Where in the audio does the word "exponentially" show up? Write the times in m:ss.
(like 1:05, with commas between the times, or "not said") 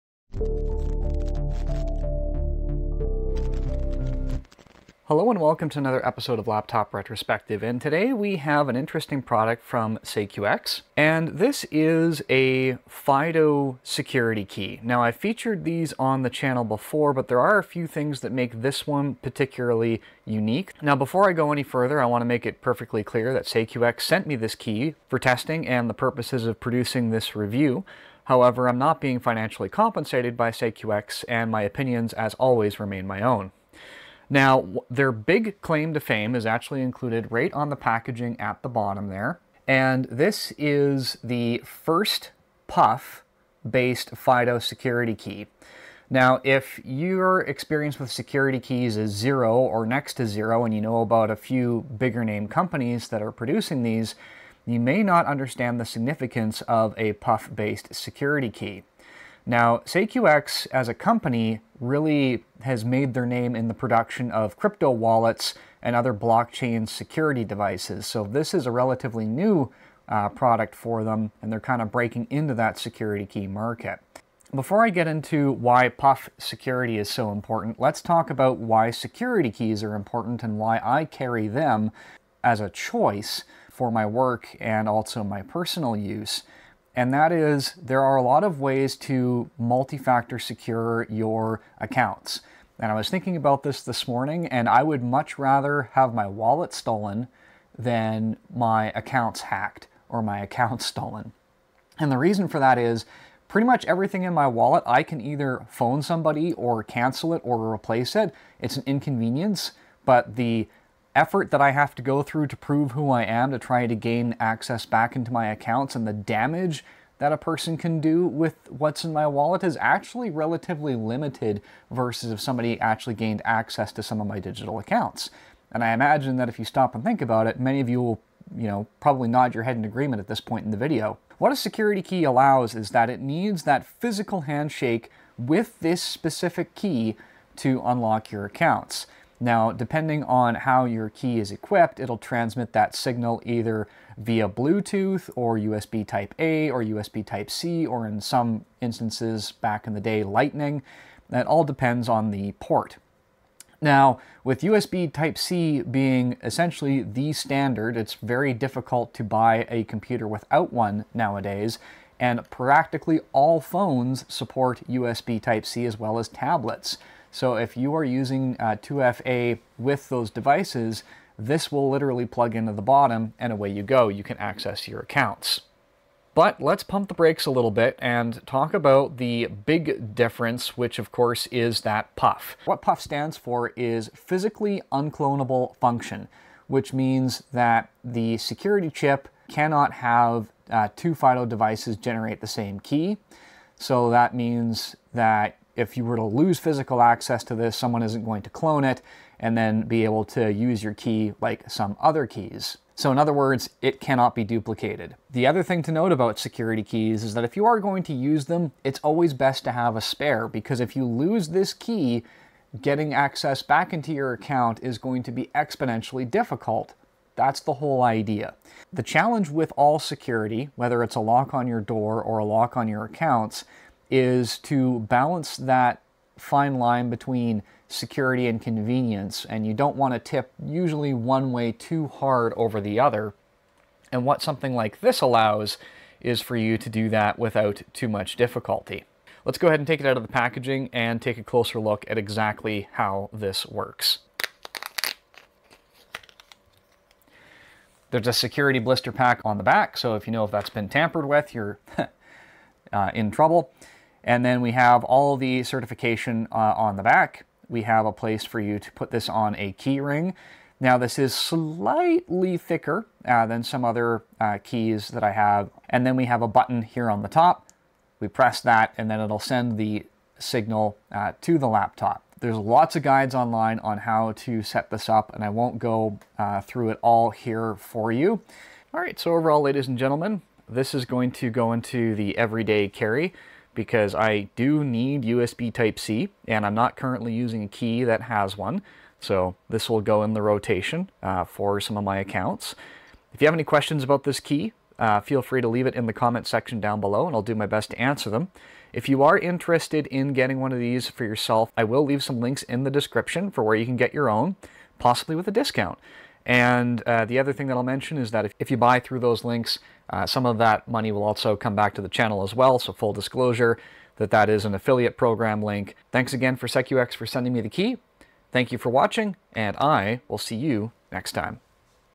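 3:35.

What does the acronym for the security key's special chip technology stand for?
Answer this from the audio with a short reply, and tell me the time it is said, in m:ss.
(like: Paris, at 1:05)
Physically unclonable function, at 3:04.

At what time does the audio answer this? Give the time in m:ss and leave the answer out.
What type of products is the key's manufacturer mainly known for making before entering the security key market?
1:04.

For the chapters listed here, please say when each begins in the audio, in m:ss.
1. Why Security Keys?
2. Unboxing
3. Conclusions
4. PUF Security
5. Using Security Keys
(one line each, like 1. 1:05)
1. 1:14
2. 3:59
3. 4:38
4. 2:56
5. 3:25.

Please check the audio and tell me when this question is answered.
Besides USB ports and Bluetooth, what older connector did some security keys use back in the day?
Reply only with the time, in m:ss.
2:30.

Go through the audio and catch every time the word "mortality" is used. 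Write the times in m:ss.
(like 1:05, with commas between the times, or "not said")
not said.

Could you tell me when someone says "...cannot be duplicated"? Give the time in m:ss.
3:23.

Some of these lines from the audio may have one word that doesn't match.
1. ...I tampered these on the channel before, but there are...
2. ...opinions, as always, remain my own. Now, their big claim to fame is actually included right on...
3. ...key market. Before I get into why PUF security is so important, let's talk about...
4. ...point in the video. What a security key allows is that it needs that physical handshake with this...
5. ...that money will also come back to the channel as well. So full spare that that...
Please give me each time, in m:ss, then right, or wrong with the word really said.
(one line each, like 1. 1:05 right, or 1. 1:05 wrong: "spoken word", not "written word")
1. 0:15 wrong: "featured", not "tampered"
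2. 0:31 right
3. 1:13 right
4. 2:10 right
5. 5:10 wrong: "disclosure", not "spare".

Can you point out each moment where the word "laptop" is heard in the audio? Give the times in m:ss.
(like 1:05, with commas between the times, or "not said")
0:06, 4:31.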